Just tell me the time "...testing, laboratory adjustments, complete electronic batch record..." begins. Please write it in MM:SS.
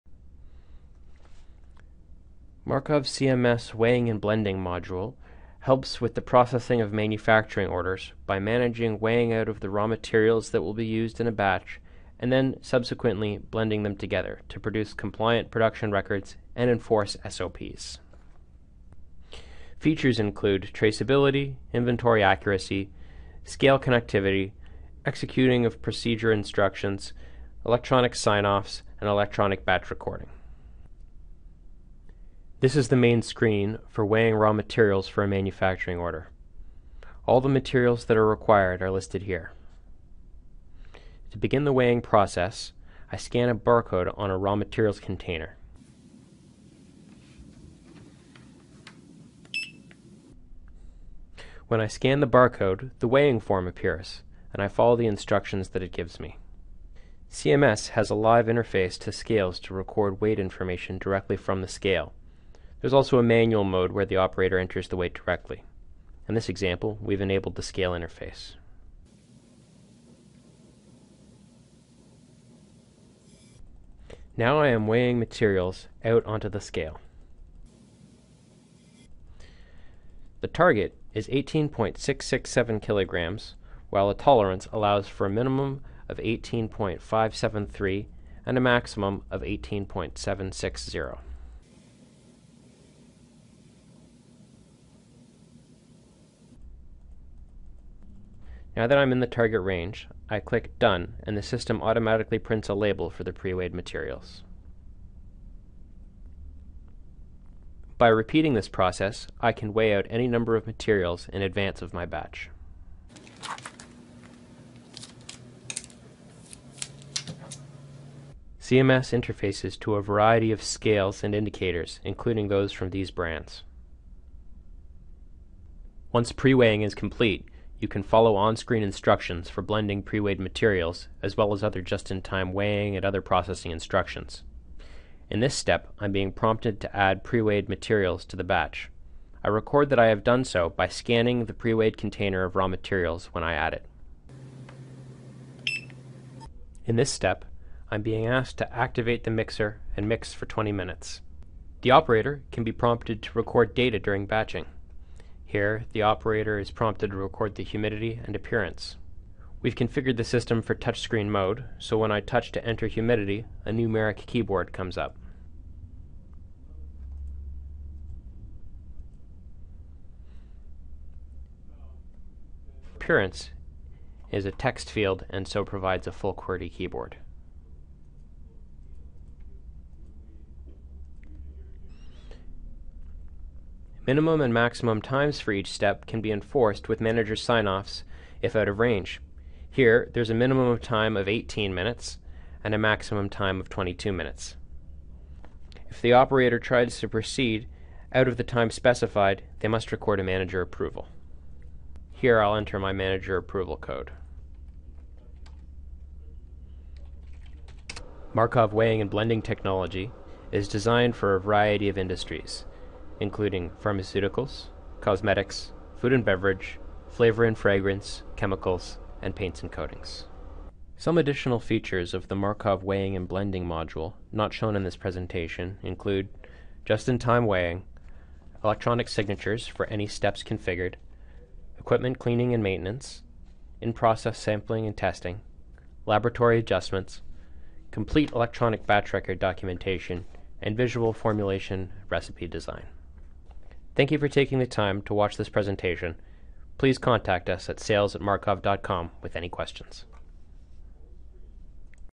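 03:54.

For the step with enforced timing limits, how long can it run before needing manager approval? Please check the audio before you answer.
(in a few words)
22 minutes.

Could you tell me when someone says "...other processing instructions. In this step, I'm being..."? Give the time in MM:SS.
02:13.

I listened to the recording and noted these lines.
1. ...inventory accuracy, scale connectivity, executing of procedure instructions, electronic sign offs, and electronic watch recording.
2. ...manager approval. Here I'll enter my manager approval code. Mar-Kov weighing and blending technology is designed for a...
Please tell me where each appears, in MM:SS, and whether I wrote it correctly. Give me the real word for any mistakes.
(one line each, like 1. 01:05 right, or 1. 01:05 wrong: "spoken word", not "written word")
1. 00:21 wrong: "batch", not "watch"
2. 03:20 right.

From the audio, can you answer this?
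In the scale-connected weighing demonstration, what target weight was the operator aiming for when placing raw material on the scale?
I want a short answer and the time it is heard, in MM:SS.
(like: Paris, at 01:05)
18.667 kilograms, at 01:21.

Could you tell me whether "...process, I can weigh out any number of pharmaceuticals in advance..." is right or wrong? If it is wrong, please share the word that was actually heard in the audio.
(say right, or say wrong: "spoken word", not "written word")
wrong: "materials", not "pharmaceuticals".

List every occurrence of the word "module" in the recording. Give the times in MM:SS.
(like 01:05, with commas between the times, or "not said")
00:04, 03:43.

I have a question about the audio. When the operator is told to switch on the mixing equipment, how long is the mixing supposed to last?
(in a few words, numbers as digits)
20 minutes.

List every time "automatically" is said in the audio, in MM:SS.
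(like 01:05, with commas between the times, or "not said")
01:41.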